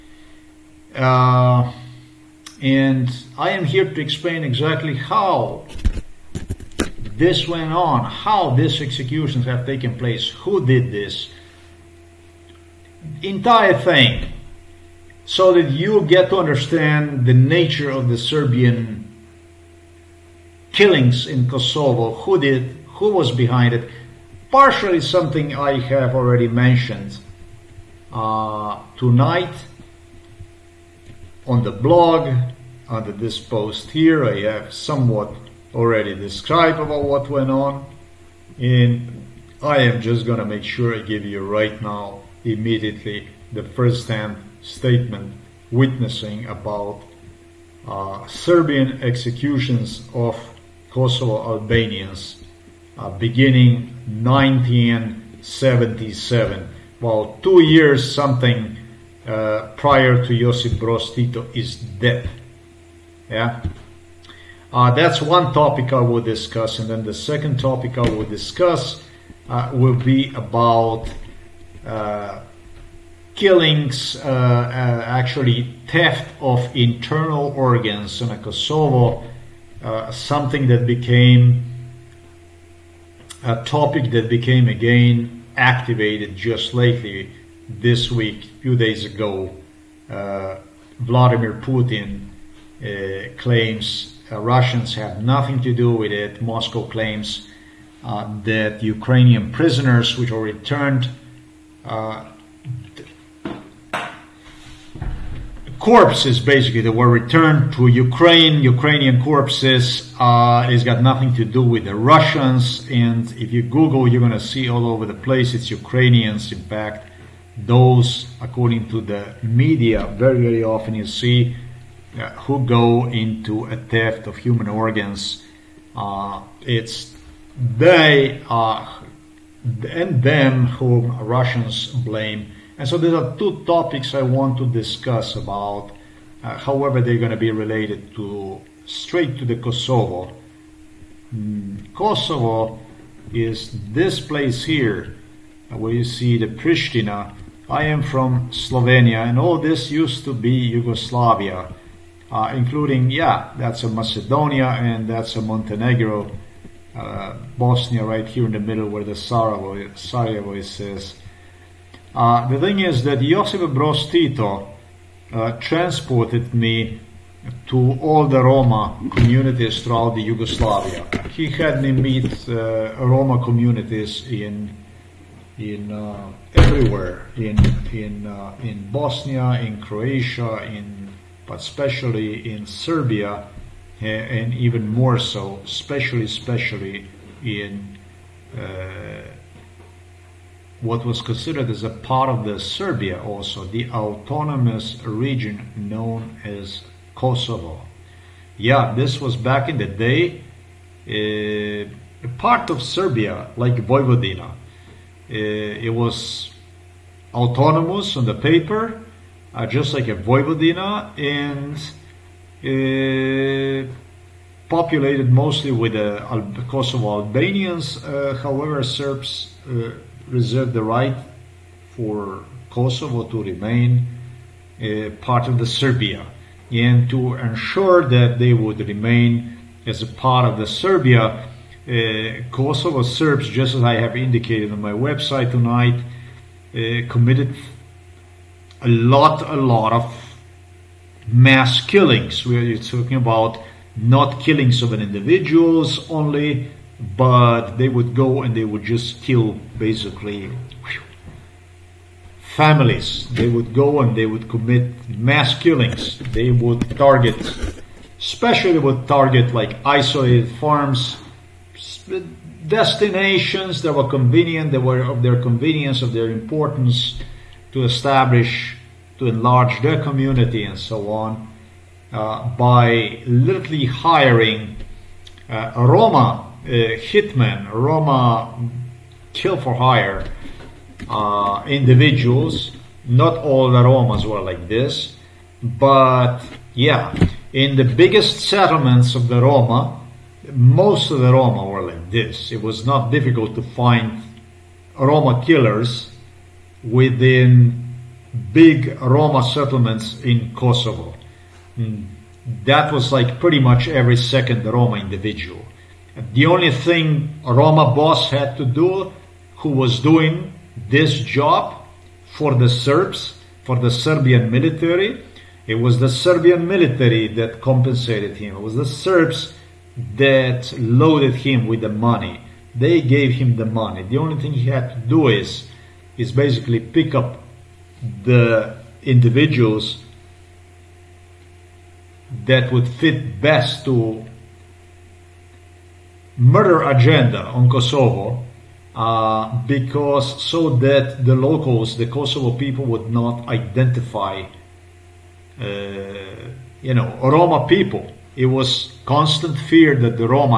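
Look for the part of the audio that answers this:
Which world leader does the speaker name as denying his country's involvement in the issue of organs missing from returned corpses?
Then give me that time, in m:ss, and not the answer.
1:30.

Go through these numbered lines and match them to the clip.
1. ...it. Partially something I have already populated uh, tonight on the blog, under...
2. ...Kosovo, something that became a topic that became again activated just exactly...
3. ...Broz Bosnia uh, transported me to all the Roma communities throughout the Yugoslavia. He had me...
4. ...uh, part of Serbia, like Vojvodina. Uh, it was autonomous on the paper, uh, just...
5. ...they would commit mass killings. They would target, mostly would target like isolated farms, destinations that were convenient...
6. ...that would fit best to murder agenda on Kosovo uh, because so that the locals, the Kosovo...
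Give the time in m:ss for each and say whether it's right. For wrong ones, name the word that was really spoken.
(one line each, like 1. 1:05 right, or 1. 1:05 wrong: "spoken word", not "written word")
1. 0:23 wrong: "mentioned", not "populated"
2. 1:18 wrong: "lately", not "exactly"
3. 2:43 wrong: "Tito", not "Bosnia"
4. 3:21 right
5. 4:14 wrong: "especially", not "mostly"
6. 5:32 right.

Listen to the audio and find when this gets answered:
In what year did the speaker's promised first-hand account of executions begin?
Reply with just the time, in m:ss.
0:54.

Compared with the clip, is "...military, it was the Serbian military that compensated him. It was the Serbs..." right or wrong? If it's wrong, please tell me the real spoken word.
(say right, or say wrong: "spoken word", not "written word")
right.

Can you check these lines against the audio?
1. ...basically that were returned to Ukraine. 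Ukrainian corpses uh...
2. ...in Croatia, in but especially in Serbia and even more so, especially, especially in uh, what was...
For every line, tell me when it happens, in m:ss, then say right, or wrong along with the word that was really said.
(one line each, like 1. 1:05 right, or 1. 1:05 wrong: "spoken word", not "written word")
1. 1:46 right
2. 2:59 right.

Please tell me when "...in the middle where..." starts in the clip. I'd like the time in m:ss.
2:38.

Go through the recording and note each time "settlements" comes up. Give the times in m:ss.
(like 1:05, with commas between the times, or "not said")
4:48, 4:59.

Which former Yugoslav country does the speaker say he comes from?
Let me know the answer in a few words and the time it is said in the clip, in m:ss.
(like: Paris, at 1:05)
Slovenia, at 2:28.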